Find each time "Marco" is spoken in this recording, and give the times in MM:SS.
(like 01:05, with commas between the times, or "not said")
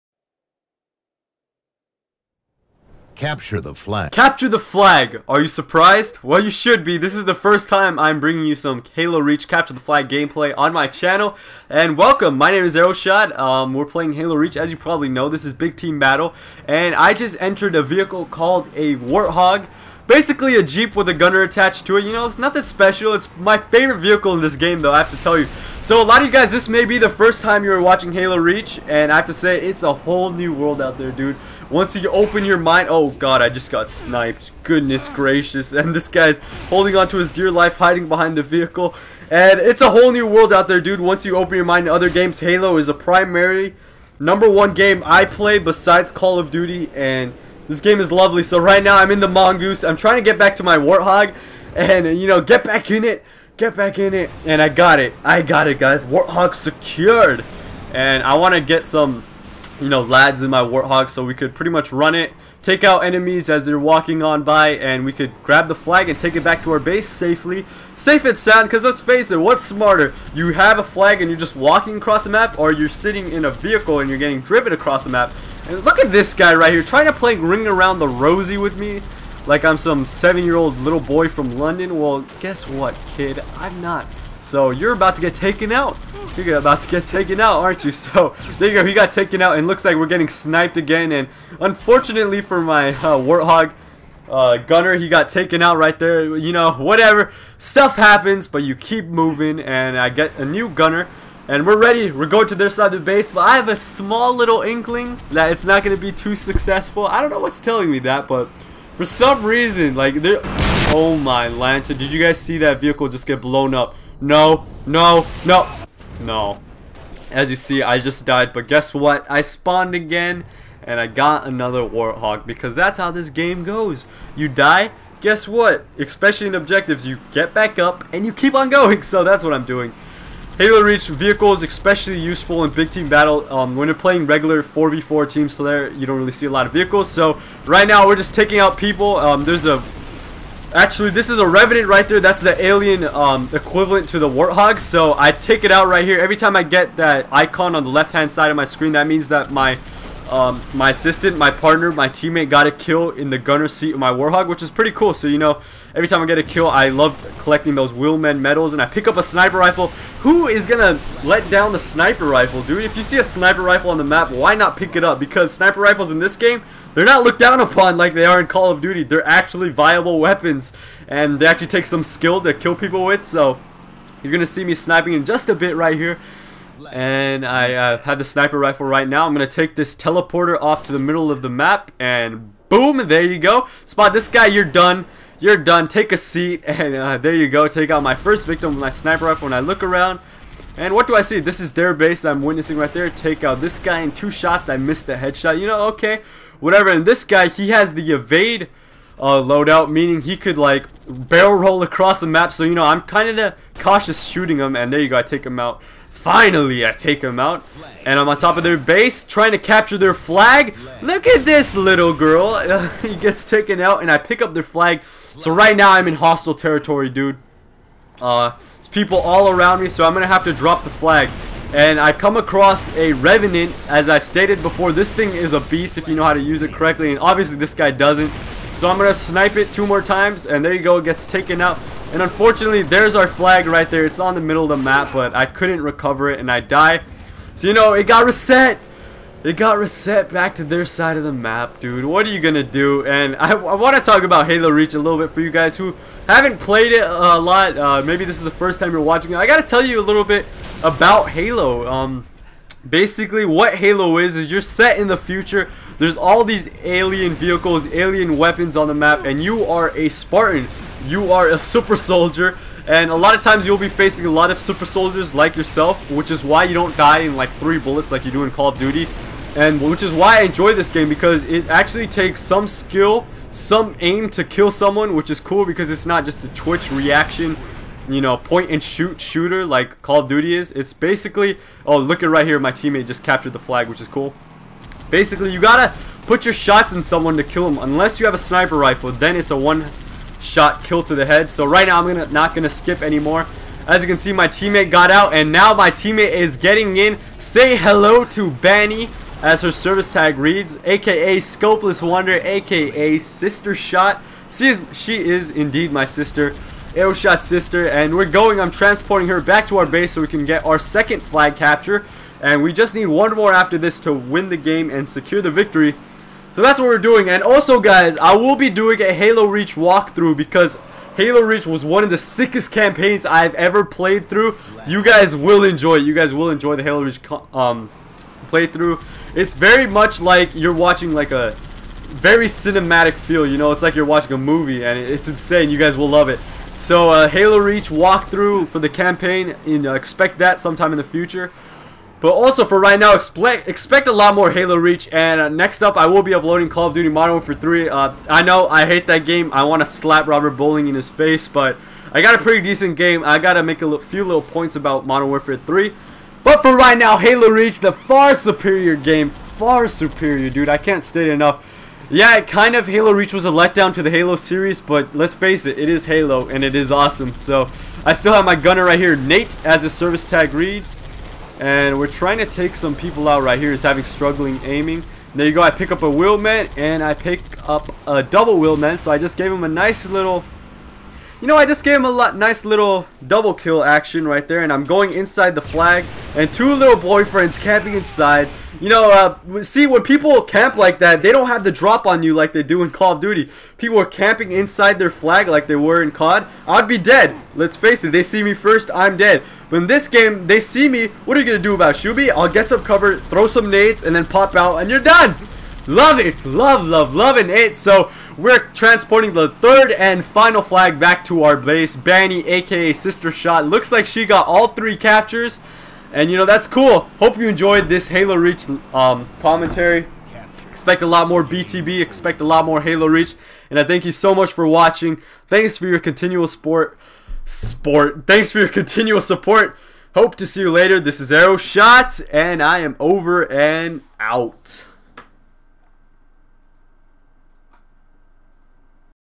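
not said.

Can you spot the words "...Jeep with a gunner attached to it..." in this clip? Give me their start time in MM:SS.
00:20.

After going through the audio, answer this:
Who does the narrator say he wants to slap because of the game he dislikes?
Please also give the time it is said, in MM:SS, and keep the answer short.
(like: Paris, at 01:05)
Robert Bowling, at 05:50.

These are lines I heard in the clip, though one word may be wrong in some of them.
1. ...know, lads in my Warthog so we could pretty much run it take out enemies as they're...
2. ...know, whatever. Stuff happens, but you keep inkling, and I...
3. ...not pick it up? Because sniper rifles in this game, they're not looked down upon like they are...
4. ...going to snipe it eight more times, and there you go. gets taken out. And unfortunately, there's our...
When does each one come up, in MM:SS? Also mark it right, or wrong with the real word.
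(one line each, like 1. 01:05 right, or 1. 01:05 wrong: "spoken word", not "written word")
1. 00:59 right
2. 01:36 wrong: "moving", not "inkling"
3. 02:44 right
4. 03:48 wrong: "two", not "eight".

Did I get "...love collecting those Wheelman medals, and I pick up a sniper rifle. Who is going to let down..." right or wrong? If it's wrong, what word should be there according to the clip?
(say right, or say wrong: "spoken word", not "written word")
right.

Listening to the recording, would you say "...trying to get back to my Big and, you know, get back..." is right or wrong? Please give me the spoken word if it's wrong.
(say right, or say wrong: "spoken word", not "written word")
wrong: "Warthog", not "Big".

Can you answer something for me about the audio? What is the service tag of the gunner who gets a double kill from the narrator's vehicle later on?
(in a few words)
Nate.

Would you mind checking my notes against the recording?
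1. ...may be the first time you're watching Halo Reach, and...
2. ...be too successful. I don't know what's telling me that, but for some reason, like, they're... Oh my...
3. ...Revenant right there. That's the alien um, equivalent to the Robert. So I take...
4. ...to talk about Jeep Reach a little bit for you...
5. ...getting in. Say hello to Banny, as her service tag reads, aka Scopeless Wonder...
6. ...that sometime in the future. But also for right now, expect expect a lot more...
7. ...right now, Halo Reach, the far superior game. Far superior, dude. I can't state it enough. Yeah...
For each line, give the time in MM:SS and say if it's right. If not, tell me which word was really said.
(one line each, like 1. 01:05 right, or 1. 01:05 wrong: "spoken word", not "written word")
1. 00:26 right
2. 01:46 right
3. 02:21 wrong: "Warthog", not "Robert"
4. 04:03 wrong: "Halo", not "Jeep"
5. 04:56 right
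6. 05:40 right
7. 05:56 right.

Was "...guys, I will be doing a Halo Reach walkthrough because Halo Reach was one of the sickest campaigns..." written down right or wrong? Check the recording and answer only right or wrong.
right.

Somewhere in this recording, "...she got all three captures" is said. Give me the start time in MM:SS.
06:54.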